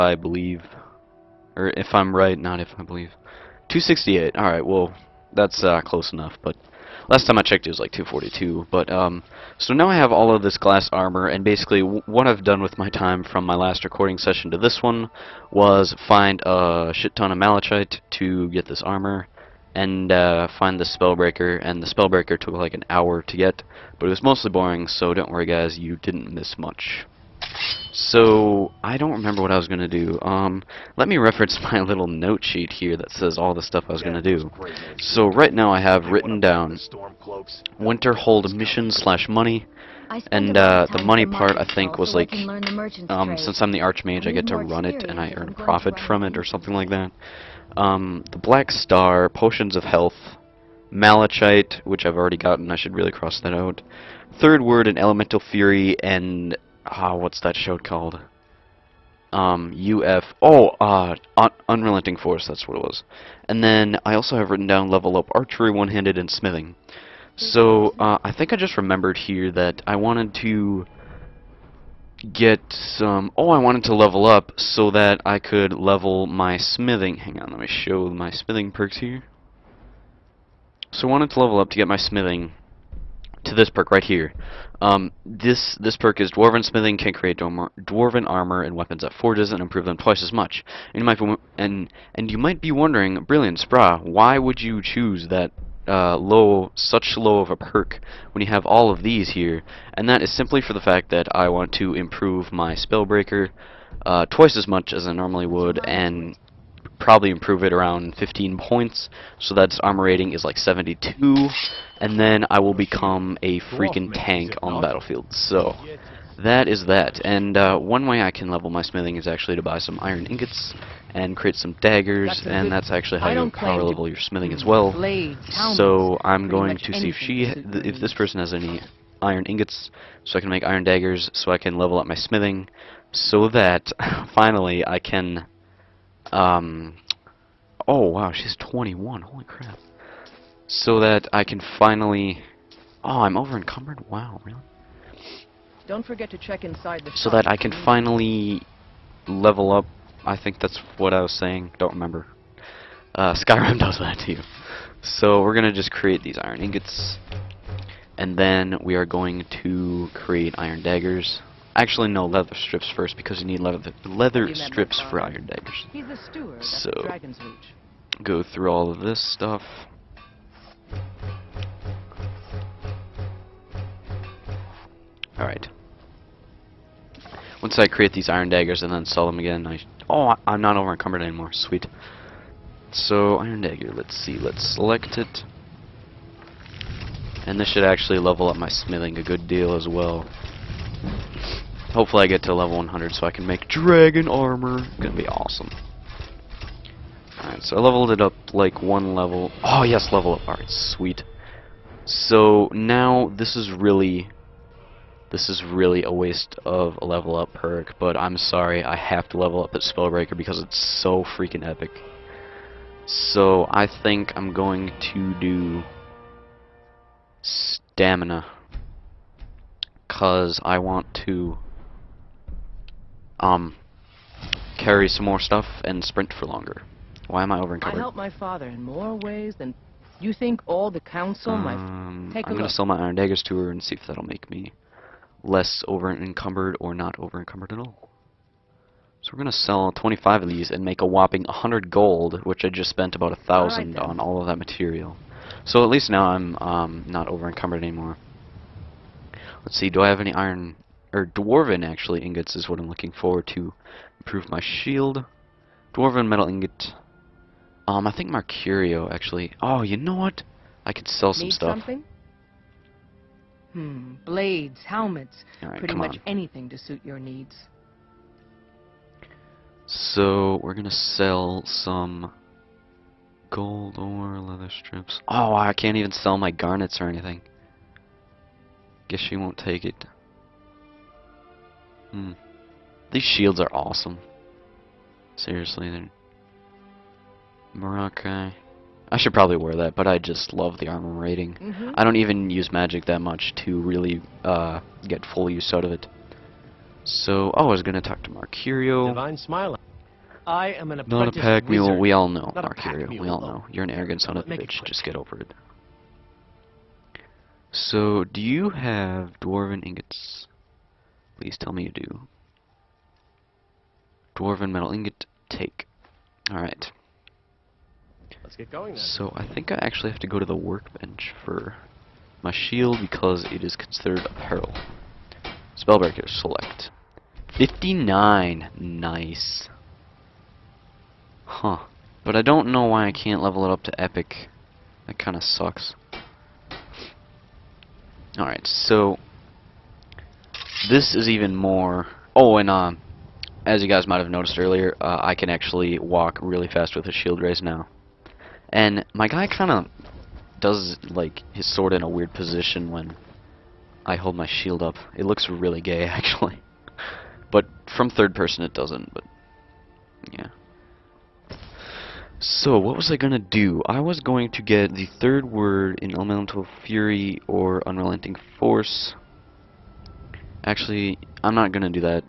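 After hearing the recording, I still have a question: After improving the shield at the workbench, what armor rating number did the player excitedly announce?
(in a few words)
59.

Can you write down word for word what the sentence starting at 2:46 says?
so, go through all of this stuff.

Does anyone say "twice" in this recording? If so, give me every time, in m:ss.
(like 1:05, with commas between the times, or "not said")
1:29, 1:44.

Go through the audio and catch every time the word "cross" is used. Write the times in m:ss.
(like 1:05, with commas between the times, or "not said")
0:53.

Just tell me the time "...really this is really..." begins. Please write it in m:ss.
3:23.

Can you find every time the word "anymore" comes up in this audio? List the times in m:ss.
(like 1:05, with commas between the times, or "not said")
3:01, 4:07.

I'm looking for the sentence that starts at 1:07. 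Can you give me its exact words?
So, uh, I think I just remembered here that I wanted to get some.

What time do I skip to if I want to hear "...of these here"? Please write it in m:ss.
1:38.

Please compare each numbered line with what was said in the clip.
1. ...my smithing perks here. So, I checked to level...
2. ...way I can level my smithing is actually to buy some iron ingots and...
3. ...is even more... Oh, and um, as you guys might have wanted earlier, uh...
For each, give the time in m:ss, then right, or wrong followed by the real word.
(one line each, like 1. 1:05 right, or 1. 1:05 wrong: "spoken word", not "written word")
1. 1:18 wrong: "wanted", not "checked"
2. 1:58 right
3. 5:41 wrong: "noticed", not "wanted".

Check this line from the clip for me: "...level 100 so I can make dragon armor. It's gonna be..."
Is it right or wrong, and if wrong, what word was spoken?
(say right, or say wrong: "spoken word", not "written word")
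right.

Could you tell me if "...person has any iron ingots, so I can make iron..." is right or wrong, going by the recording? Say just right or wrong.
right.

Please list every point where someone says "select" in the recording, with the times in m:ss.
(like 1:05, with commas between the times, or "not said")
3:04, 5:26.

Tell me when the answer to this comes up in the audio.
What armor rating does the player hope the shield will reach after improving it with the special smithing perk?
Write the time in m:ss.
1:50.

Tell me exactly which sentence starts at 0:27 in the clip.
So, I don't remember what I was going to do.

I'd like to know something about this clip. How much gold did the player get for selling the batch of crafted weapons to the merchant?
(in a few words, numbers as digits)
100 gold.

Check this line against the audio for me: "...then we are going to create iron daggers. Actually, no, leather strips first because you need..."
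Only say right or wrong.
right.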